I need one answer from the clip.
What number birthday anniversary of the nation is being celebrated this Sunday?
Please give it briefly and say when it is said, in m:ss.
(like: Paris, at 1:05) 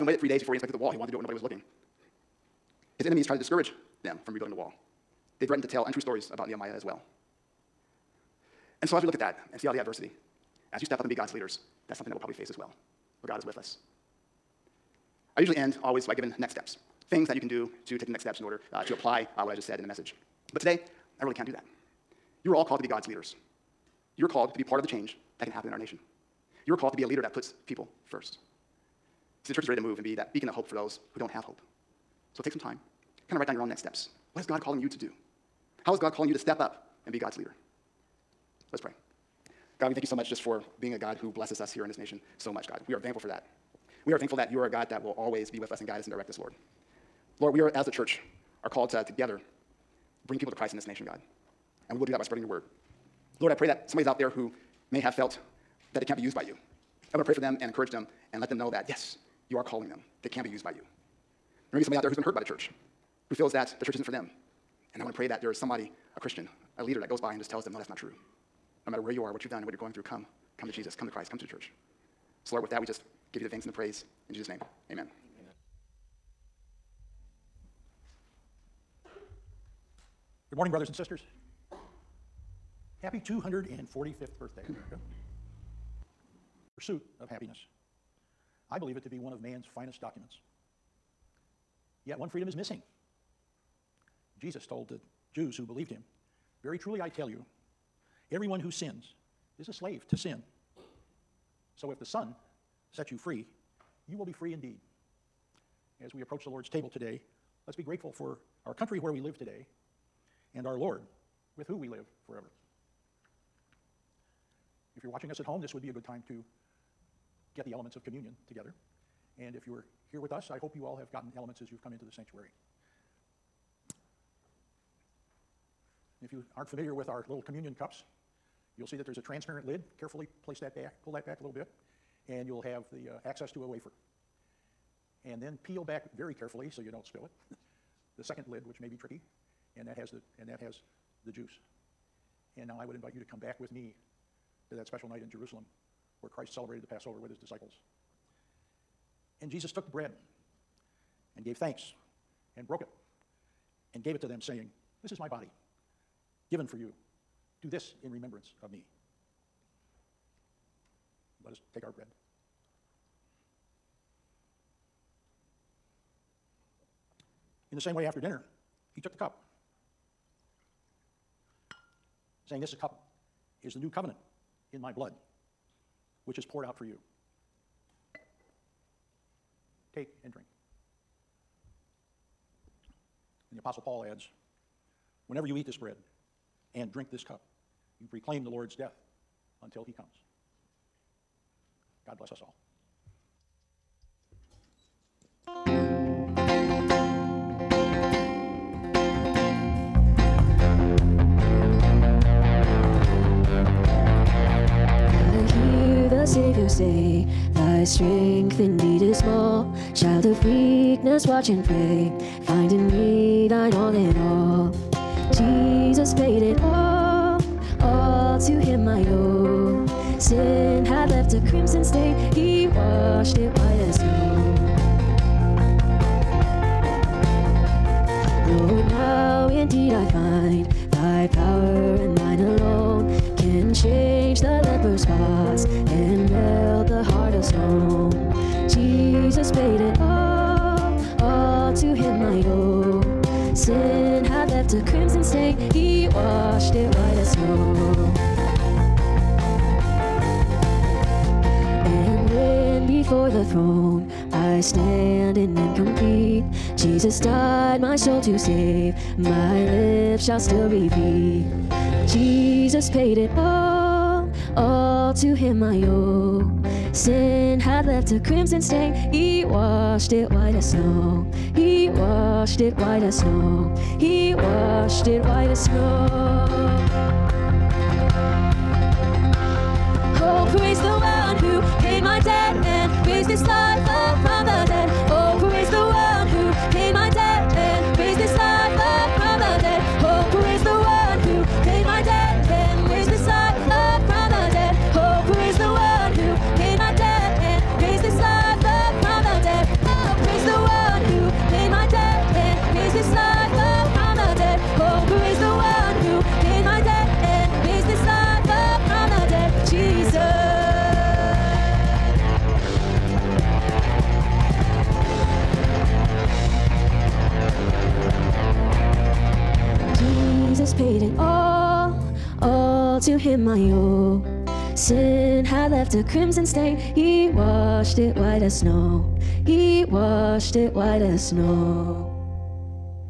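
245th, at 1:23.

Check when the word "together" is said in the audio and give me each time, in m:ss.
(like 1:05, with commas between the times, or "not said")
0:49, 1:58.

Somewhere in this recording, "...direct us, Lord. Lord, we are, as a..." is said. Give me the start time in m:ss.
0:46.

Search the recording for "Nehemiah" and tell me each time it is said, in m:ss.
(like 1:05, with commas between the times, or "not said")
0:06.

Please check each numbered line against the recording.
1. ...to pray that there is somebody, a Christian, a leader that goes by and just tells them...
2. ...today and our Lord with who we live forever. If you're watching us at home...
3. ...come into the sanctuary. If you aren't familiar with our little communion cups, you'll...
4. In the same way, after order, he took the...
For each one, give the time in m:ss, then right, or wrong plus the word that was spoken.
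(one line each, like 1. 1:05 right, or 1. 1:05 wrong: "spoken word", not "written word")
1. 1:05 right
2. 1:49 right
3. 2:01 right
4. 2:47 wrong: "dinner", not "order".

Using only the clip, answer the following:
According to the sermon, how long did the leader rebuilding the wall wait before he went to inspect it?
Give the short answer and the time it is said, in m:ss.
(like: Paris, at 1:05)
3 days, at 0:00.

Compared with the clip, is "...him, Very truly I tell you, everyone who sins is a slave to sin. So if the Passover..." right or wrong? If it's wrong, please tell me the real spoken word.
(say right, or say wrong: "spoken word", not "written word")
wrong: "Son", not "Passover".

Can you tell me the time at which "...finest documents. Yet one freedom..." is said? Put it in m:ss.
1:29.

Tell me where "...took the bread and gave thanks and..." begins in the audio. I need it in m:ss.
2:29.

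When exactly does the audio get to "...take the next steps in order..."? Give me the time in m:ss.
0:17.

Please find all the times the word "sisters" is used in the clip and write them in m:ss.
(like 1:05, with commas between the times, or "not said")
1:20.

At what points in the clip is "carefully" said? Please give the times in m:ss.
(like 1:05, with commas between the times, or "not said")
2:10, 2:16.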